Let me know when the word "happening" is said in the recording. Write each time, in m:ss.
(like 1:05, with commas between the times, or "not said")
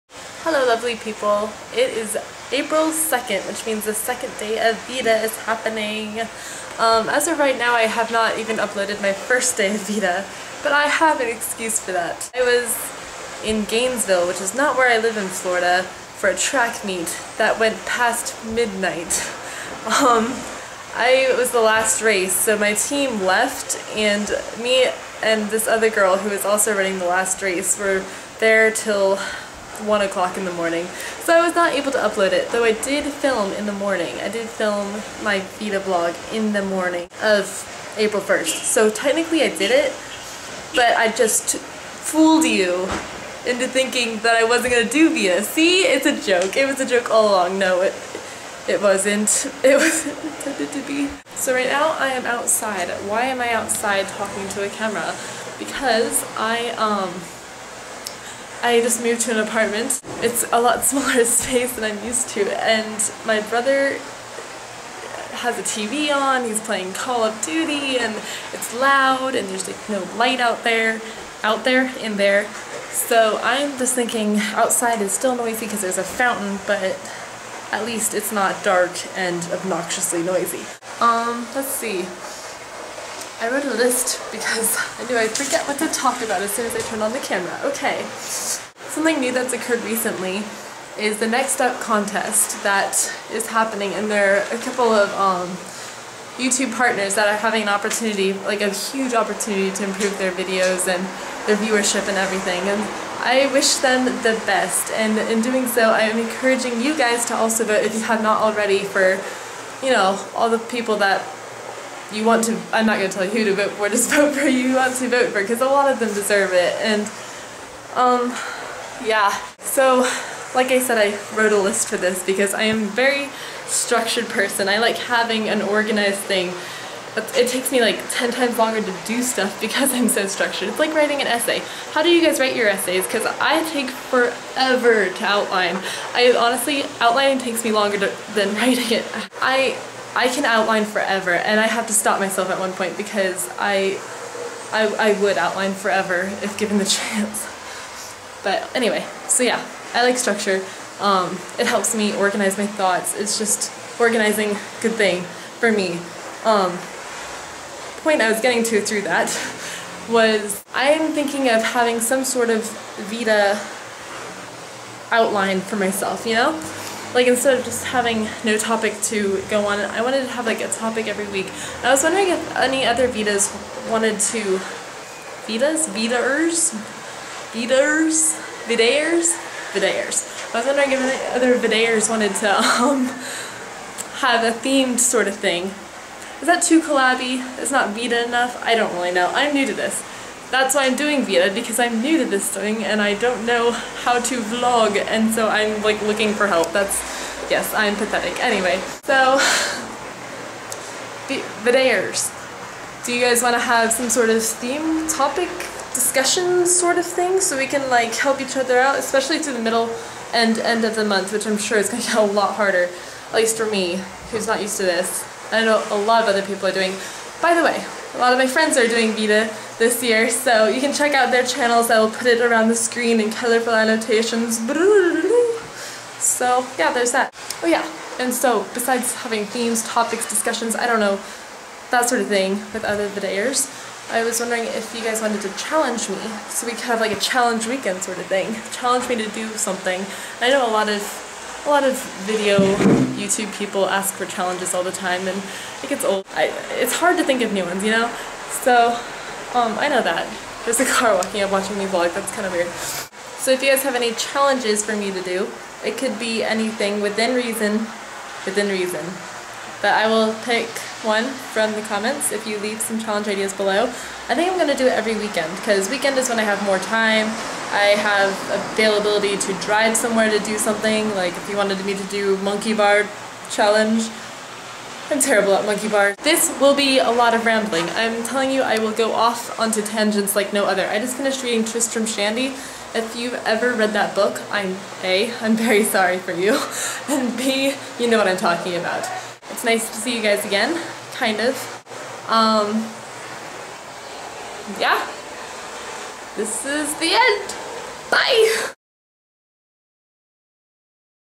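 0:05, 1:33.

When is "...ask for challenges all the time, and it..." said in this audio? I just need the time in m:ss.
4:03.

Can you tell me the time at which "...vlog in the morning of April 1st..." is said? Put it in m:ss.
0:35.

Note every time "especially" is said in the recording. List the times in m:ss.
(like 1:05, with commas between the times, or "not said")
3:28.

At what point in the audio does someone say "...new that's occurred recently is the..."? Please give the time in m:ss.
1:29.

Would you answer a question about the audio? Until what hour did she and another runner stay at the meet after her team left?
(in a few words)
1 o'clock.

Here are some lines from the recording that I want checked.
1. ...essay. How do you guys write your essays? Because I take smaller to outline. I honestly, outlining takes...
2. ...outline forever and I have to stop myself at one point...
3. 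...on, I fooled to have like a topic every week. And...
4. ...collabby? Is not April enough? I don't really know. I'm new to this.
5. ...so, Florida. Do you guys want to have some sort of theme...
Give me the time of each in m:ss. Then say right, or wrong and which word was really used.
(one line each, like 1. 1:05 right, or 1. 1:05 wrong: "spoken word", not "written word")
1. 2:11 wrong: "forever", not "smaller"
2. 2:20 right
3. 2:49 wrong: "wanted", not "fooled"
4. 3:06 wrong: "VEDA", not "April"
5. 3:19 wrong: "Vidairs", not "Florida".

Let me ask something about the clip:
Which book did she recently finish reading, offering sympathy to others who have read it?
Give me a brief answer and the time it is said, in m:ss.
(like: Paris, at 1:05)
Tristram Shandy, at 4:41.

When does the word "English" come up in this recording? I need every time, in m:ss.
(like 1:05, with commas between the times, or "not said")
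not said.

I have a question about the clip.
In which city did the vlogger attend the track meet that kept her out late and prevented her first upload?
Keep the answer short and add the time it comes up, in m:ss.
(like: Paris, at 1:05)
Gainesville, at 0:13.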